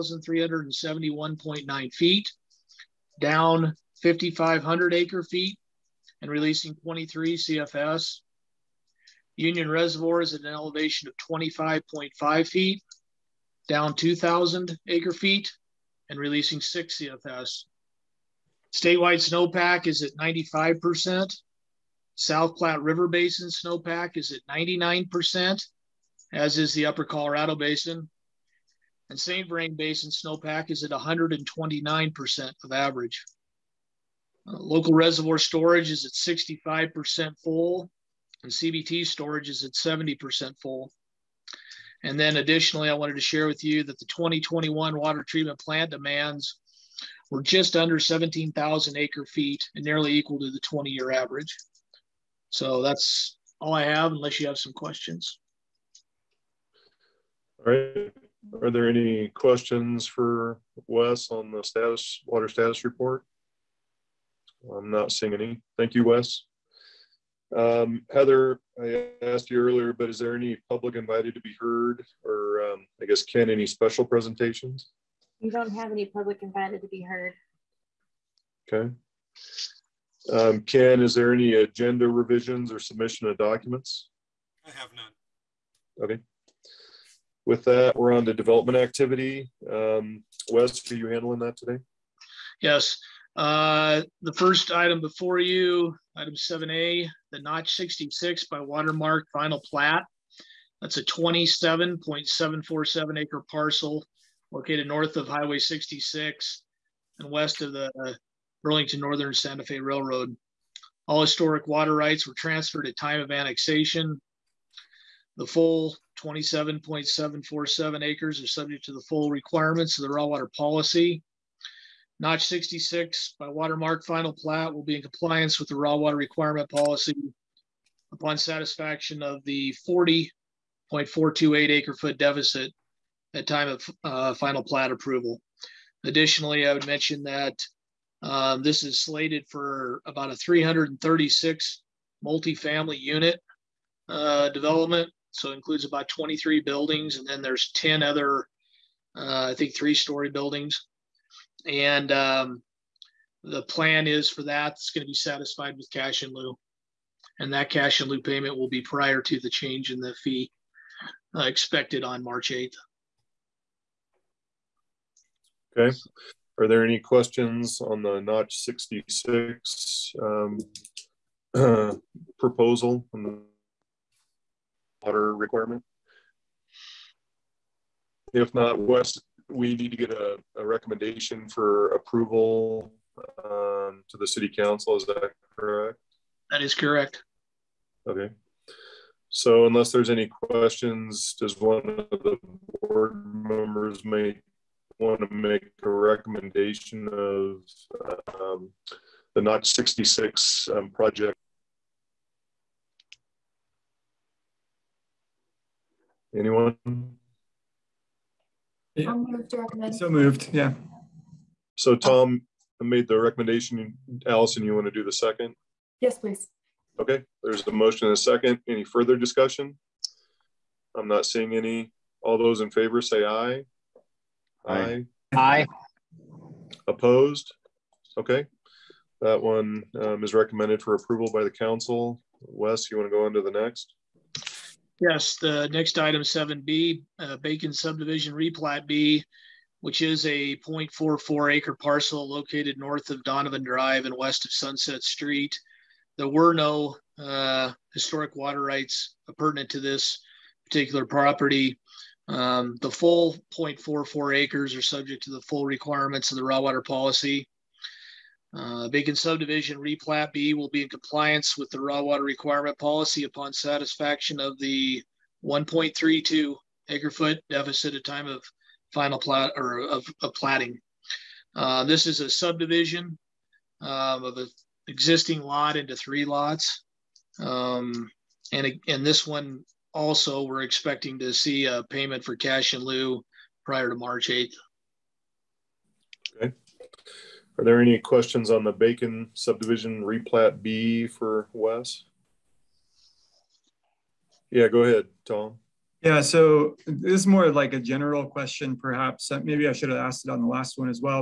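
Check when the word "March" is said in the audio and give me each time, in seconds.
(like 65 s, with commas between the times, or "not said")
162 s, 283 s.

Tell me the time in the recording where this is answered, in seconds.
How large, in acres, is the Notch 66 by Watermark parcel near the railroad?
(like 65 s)
101 s.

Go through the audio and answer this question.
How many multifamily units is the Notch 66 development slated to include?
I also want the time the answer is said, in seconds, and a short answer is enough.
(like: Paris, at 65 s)
336, at 140 s.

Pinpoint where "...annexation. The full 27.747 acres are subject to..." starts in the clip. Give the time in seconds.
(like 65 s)
113 s.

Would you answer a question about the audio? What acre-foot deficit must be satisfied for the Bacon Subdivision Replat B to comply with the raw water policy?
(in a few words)
1.32 acre feet.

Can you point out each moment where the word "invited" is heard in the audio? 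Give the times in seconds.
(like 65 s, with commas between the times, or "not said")
70 s, 76 s.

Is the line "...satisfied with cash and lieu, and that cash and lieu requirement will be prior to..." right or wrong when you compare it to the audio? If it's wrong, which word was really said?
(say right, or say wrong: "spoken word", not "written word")
wrong: "payment", not "requirement".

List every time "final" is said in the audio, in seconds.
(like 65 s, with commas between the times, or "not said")
99 s, 124 s, 134 s, 268 s.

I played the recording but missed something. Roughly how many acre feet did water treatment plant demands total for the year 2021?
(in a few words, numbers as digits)
just under 17,000 acre feet.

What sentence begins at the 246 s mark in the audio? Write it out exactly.
There were no uh, historic water rights pertinent to this particular property.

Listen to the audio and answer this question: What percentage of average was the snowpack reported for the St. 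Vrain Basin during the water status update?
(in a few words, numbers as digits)
129%.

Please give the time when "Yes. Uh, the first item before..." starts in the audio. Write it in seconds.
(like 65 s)
92 s.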